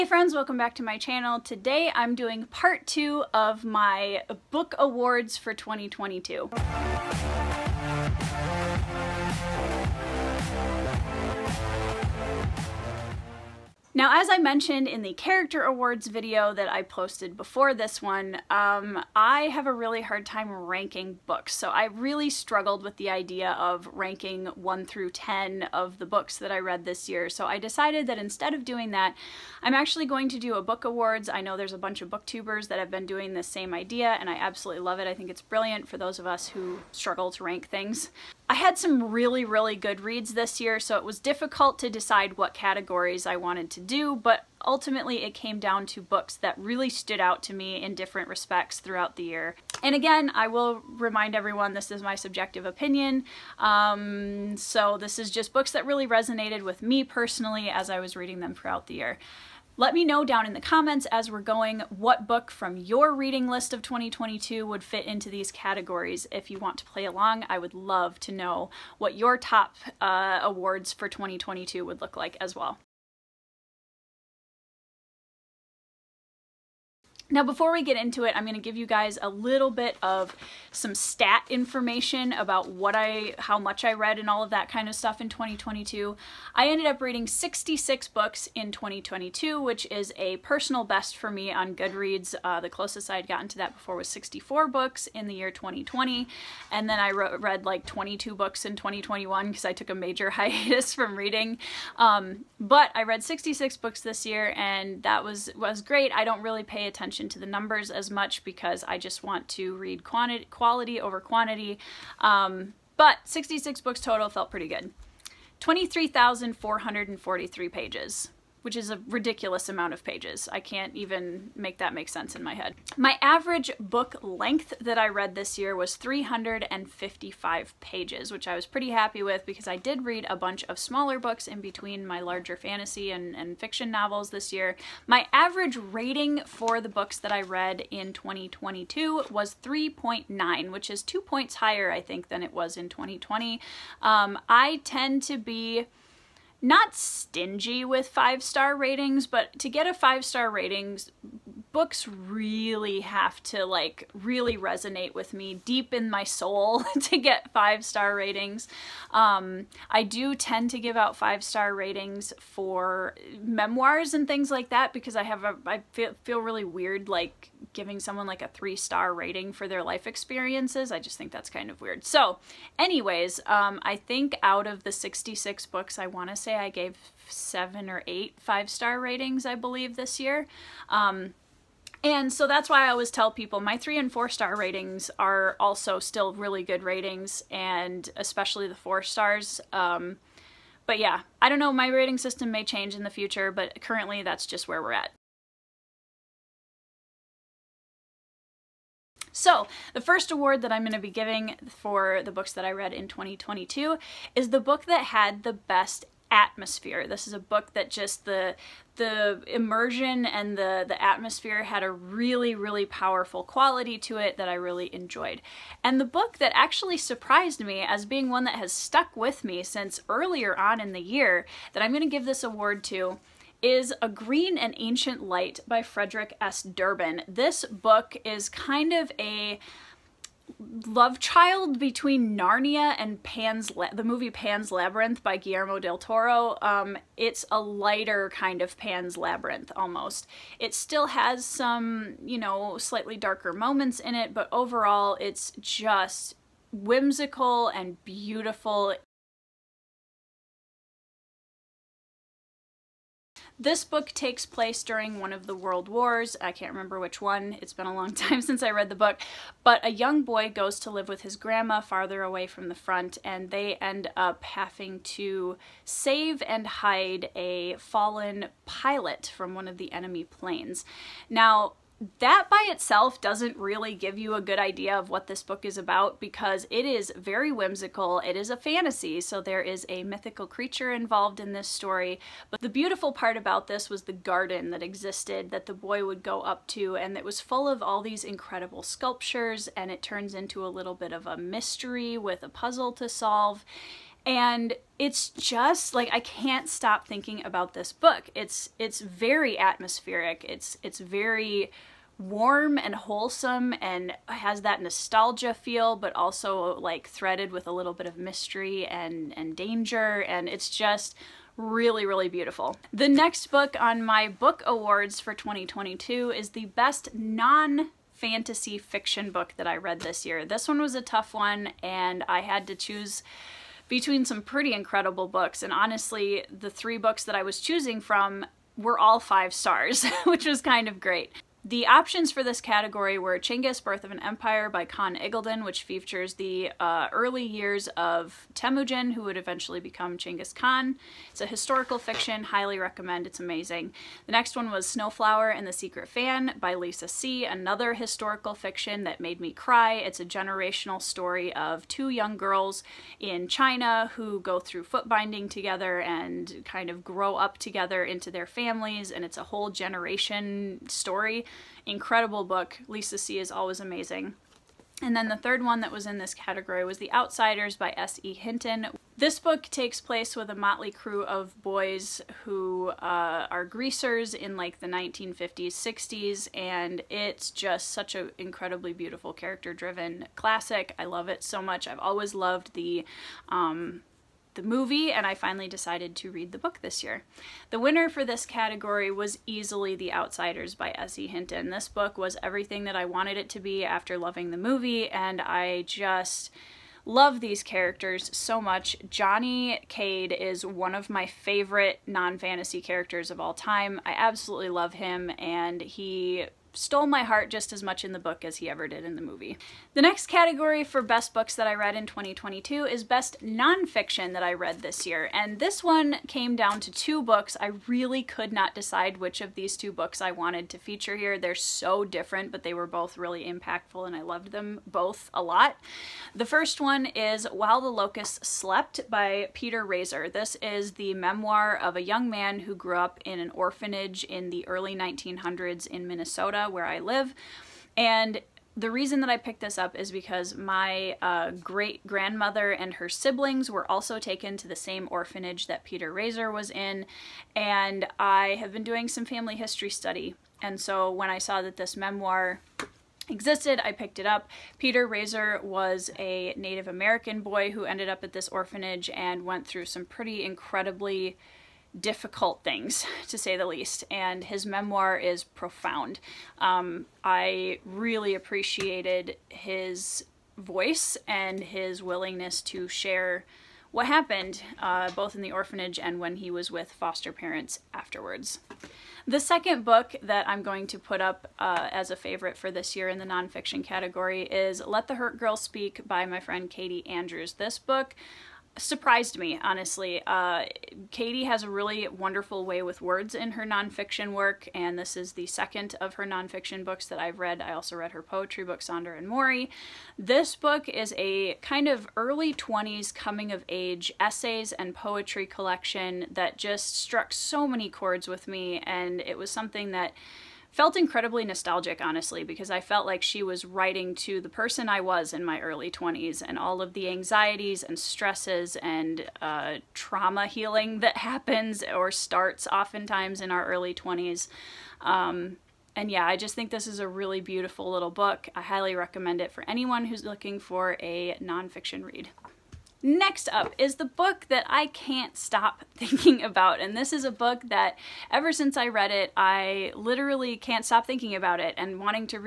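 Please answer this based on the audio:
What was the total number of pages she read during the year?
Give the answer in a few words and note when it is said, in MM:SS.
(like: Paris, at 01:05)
23,443, at 01:55.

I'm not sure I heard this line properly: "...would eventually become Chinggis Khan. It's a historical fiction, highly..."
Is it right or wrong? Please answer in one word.
right.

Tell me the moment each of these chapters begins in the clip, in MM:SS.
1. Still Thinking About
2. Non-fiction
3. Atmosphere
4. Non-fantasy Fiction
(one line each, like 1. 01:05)
1. 08:51
2. 06:49
3. 03:15
4. 05:12.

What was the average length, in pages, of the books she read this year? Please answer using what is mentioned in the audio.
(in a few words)
355.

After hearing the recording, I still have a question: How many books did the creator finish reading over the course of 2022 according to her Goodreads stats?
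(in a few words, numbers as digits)
66.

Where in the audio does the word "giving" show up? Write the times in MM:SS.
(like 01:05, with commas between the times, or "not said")
02:47, 03:21.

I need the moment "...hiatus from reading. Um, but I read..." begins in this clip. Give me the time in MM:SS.
01:40.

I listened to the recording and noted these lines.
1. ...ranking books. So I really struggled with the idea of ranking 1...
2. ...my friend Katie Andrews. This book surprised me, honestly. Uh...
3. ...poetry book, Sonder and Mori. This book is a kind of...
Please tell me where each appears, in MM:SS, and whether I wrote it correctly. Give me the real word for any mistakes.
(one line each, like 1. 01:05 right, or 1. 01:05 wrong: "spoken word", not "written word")
1. 00:20 right
2. 08:06 right
3. 08:18 right.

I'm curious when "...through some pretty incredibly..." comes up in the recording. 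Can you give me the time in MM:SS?
07:39.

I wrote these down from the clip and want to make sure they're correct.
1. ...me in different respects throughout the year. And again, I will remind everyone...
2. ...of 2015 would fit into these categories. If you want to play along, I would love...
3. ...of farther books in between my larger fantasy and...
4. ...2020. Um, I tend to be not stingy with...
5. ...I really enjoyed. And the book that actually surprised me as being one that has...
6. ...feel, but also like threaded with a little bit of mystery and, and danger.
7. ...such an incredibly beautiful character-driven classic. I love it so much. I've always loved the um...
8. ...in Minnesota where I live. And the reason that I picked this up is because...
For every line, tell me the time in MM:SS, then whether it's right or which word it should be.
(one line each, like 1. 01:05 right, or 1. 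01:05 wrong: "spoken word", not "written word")
1. 00:47 right
2. 01:03 wrong: "2022", not "2015"
3. 02:10 wrong: "smaller", not "farther"
4. 02:22 right
5. 03:34 right
6. 05:05 right
7. 06:17 right
8. 07:15 right.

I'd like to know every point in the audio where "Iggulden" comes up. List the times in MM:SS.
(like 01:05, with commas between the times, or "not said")
05:35.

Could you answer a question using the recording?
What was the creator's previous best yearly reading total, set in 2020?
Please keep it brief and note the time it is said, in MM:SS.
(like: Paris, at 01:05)
64, at 01:34.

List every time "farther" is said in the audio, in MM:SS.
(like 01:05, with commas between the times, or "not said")
04:21.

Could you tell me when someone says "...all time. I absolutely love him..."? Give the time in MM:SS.
06:43.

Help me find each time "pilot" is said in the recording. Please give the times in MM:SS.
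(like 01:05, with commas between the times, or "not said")
04:28.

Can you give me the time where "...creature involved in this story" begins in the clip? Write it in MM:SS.
04:40.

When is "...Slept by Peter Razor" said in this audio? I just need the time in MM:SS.
07:08.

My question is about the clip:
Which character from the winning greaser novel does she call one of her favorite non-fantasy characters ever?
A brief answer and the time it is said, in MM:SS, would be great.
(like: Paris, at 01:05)
Johnny Cade, at 06:39.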